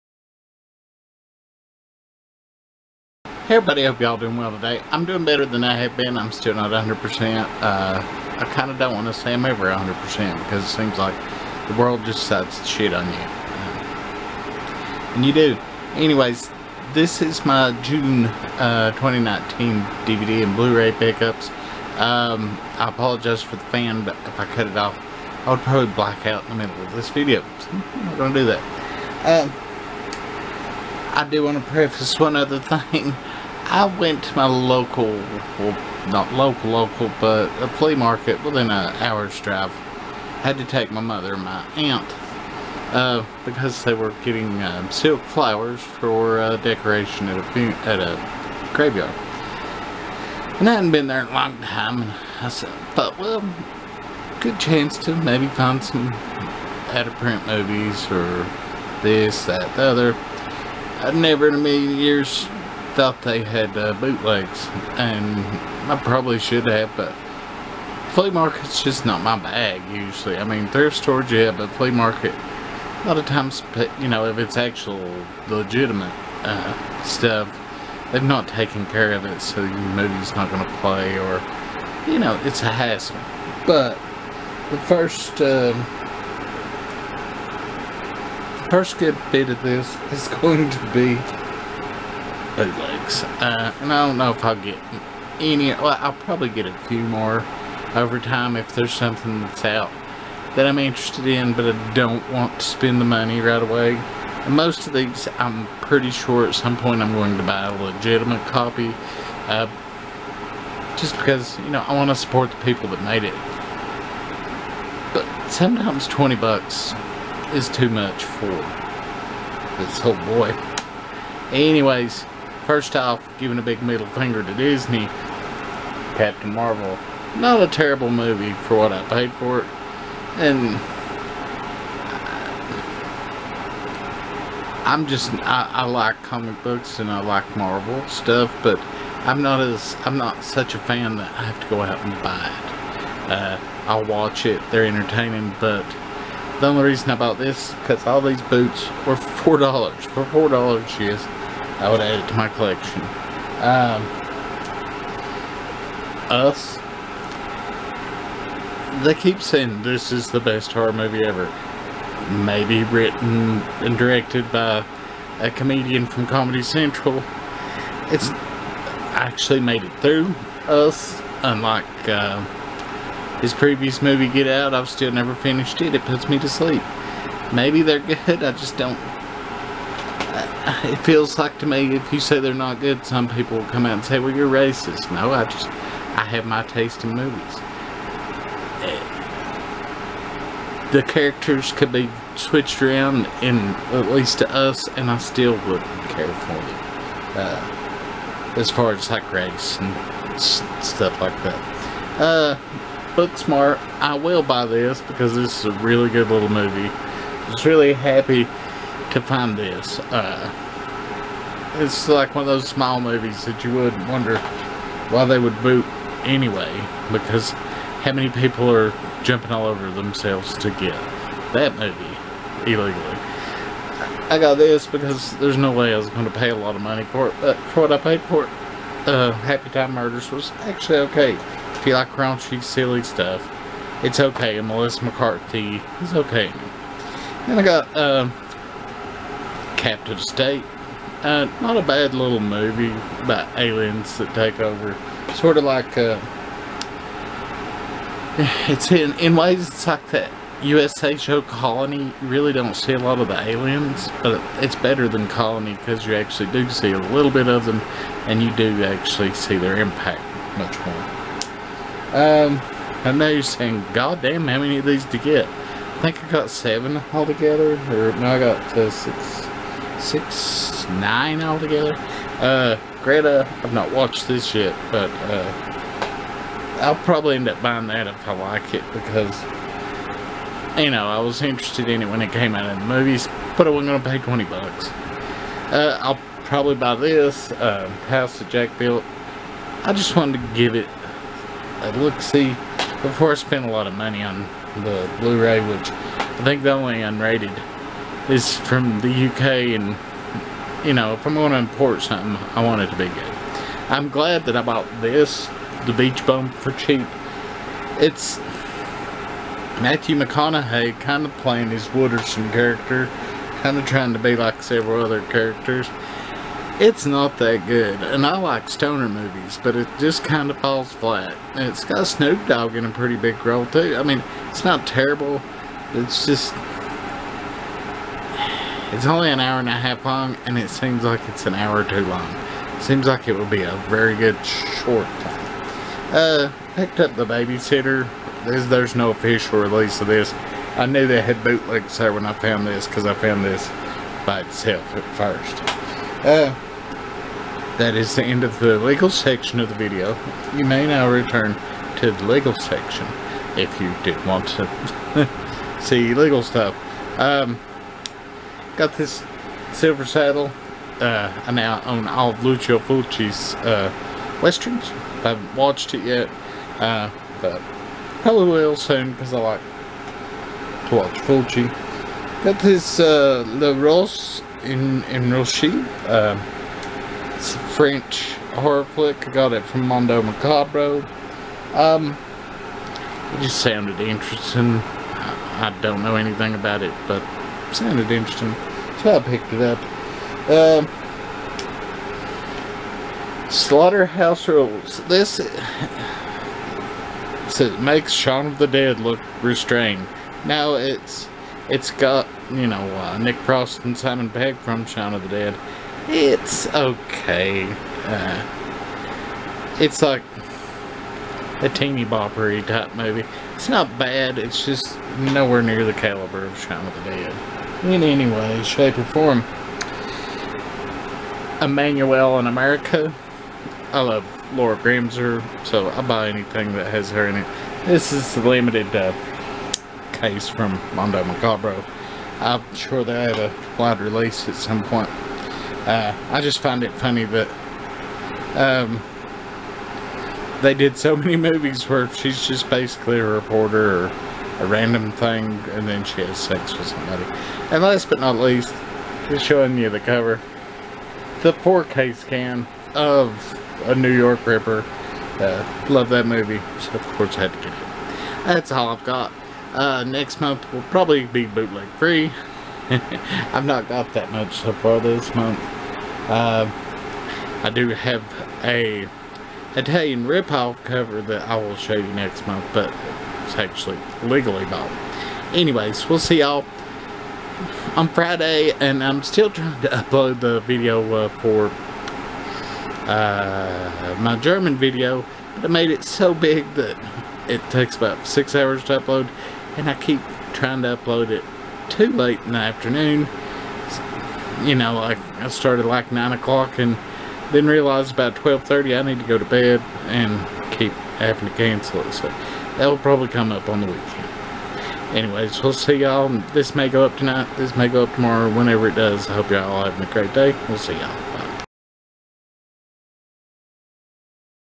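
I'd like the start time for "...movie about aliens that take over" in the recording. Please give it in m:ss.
4:02.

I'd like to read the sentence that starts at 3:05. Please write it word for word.
No, I just, I have my taste in movies.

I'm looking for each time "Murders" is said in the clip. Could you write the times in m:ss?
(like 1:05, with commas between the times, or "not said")
3:49.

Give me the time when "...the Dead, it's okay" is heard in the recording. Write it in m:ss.
6:45.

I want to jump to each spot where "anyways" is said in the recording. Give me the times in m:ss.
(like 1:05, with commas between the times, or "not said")
0:15, 2:01, 3:36, 7:55, 8:25.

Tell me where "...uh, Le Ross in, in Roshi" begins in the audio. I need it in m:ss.
6:12.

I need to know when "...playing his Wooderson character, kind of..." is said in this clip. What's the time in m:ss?
5:11.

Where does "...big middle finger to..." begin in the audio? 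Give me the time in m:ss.
2:03.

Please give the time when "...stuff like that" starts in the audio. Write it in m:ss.
3:20.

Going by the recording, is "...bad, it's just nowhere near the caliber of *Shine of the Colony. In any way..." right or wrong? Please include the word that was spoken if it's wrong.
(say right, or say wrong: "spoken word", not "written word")
wrong: "Dead", not "Colony".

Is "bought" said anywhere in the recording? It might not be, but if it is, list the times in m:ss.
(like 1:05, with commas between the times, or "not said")
5:04, 7:54.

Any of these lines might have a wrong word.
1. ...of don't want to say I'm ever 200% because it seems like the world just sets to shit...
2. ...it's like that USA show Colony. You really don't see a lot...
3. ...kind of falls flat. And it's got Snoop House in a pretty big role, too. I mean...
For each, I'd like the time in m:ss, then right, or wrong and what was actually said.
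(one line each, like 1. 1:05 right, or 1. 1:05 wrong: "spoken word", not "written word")
1. 0:08 wrong: "100", not "200"
2. 4:09 right
3. 5:20 wrong: "Dogg", not "House".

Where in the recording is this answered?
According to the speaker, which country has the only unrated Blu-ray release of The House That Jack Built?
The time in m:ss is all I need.
4:59.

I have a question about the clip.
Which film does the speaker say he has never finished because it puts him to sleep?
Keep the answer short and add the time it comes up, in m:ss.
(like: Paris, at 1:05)
Get Out, at 2:54.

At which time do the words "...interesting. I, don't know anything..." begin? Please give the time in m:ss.
6:23.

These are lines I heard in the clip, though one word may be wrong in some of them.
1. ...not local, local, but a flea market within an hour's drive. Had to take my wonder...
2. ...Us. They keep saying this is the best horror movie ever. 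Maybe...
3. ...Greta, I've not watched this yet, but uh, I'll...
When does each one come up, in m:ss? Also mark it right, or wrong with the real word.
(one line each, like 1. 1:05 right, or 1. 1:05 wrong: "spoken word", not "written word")
1. 0:36 wrong: "mother", not "wonder"
2. 2:36 right
3. 4:33 right.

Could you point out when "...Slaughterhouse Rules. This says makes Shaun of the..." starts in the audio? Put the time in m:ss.
6:33.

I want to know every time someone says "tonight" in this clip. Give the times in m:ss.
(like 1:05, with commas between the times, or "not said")
8:27.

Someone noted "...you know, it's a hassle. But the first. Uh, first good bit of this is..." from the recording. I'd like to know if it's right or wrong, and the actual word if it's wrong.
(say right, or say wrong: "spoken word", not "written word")
right.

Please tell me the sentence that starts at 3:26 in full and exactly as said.
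I was really happy to find this.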